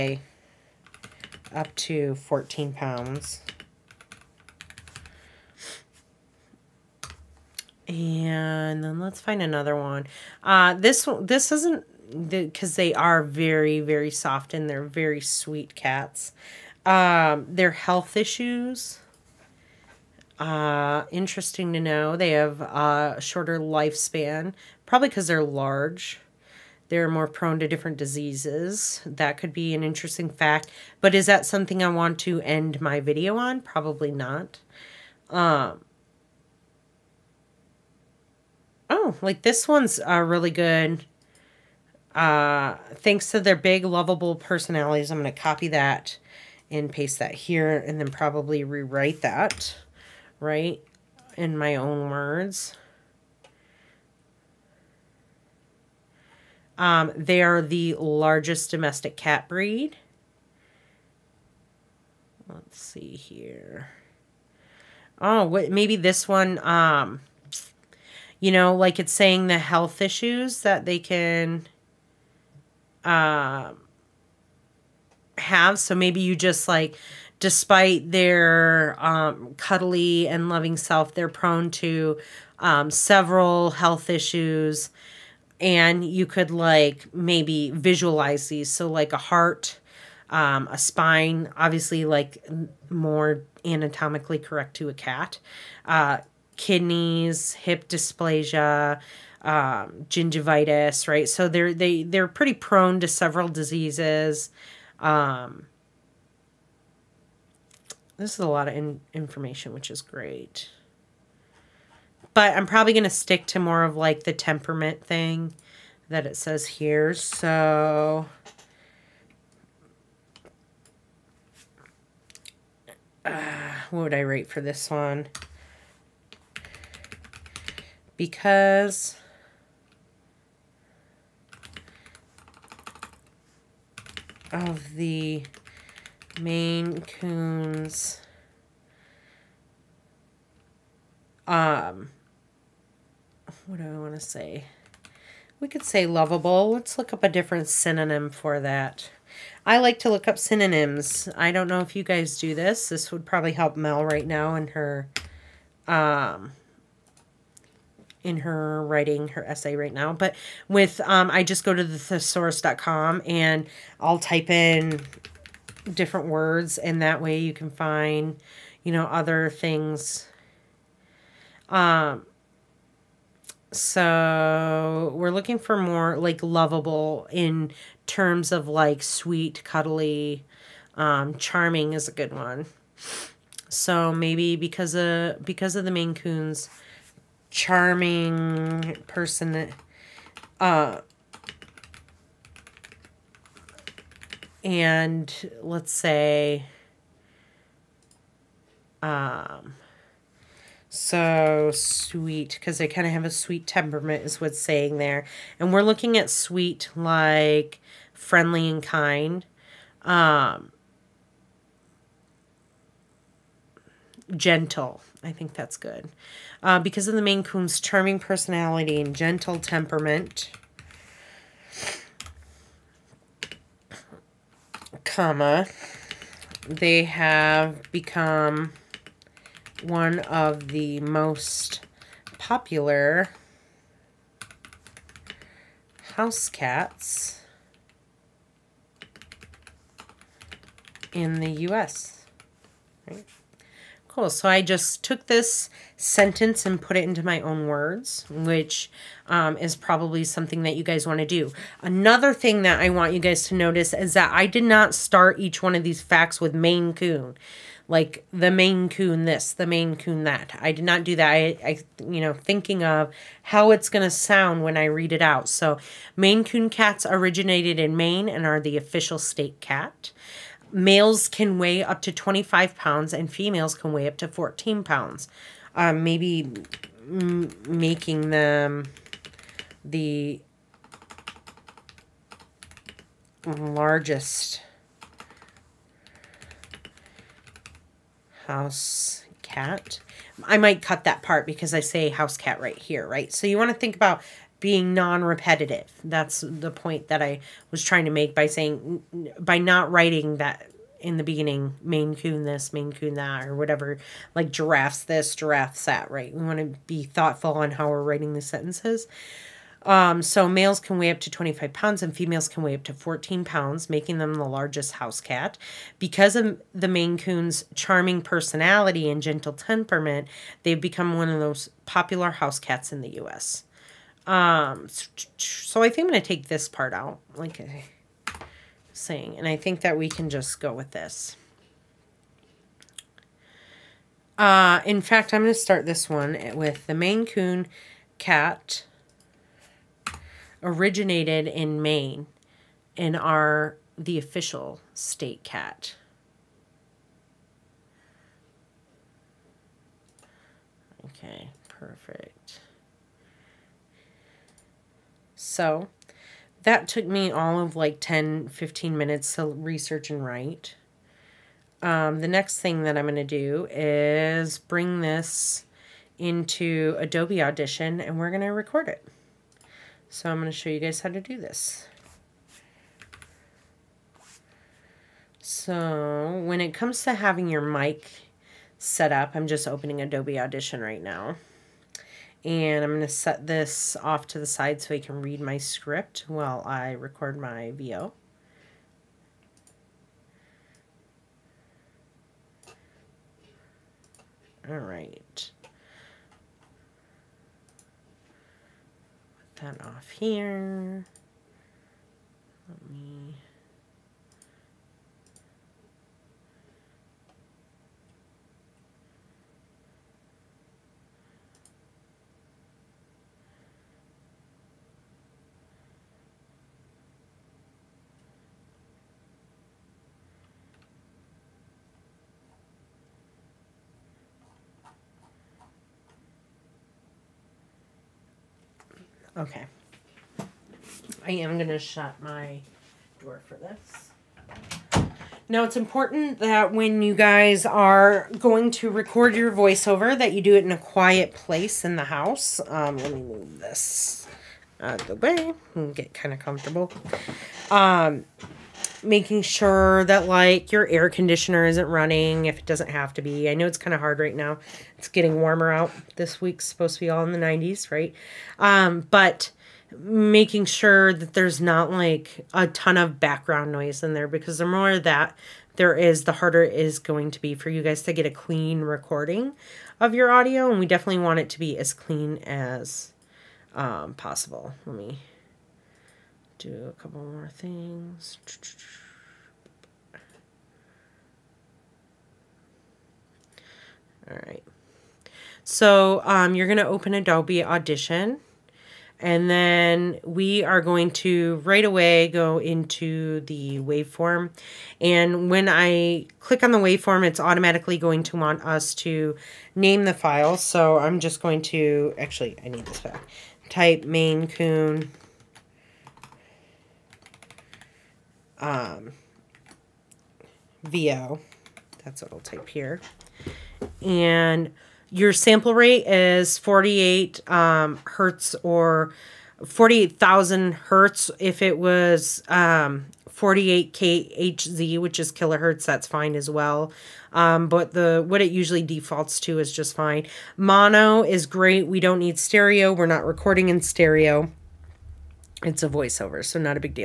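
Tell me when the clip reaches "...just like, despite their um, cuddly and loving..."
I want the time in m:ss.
1:16.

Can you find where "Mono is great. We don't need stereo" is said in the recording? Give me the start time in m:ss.
8:50.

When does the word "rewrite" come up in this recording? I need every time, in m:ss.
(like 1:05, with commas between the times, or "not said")
0:48.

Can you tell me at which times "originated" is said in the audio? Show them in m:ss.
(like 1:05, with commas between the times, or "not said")
4:27, 5:40.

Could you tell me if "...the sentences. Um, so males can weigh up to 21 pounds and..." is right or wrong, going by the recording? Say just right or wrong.
wrong.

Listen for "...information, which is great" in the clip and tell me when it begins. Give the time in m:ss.
1:49.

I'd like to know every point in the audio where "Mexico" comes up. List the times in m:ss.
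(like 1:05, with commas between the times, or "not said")
not said.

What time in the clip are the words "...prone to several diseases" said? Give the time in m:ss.
1:42.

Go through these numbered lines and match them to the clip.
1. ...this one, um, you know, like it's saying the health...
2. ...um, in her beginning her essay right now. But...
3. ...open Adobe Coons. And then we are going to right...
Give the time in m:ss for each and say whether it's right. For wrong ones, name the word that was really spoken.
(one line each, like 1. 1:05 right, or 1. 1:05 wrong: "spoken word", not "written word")
1. 1:05 right
2. 2:35 wrong: "writing", not "beginning"
3. 8:06 wrong: "Audition", not "Coons".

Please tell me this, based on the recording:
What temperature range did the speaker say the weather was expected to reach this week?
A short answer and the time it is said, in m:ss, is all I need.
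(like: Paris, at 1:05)
the 90s, at 7:37.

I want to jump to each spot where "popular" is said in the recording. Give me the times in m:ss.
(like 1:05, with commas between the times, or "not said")
3:52, 5:21.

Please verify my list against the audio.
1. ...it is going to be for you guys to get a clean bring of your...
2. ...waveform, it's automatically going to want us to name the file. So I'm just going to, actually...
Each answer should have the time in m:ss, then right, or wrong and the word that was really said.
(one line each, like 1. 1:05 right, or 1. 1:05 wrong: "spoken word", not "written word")
1. 7:46 wrong: "recording", not "bring"
2. 8:16 right.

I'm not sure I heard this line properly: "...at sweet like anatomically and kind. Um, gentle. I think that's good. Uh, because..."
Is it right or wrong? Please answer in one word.
wrong.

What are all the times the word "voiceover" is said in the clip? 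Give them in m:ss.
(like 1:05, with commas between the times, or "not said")
7:19, 8:55.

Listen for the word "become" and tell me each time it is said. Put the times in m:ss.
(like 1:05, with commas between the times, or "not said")
3:47, 5:20.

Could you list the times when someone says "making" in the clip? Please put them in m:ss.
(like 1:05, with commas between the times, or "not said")
4:37, 5:13, 7:29, 7:39.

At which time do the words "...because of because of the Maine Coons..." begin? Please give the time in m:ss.
3:04.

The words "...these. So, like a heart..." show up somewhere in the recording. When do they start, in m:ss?
1:28.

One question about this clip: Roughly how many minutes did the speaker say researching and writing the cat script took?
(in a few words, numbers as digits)
10 to 15 minutes.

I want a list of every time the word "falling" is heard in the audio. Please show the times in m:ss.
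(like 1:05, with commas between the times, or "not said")
not said.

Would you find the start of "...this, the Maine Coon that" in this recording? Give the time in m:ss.
4:19.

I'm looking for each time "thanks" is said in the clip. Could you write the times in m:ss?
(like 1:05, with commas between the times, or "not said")
0:42.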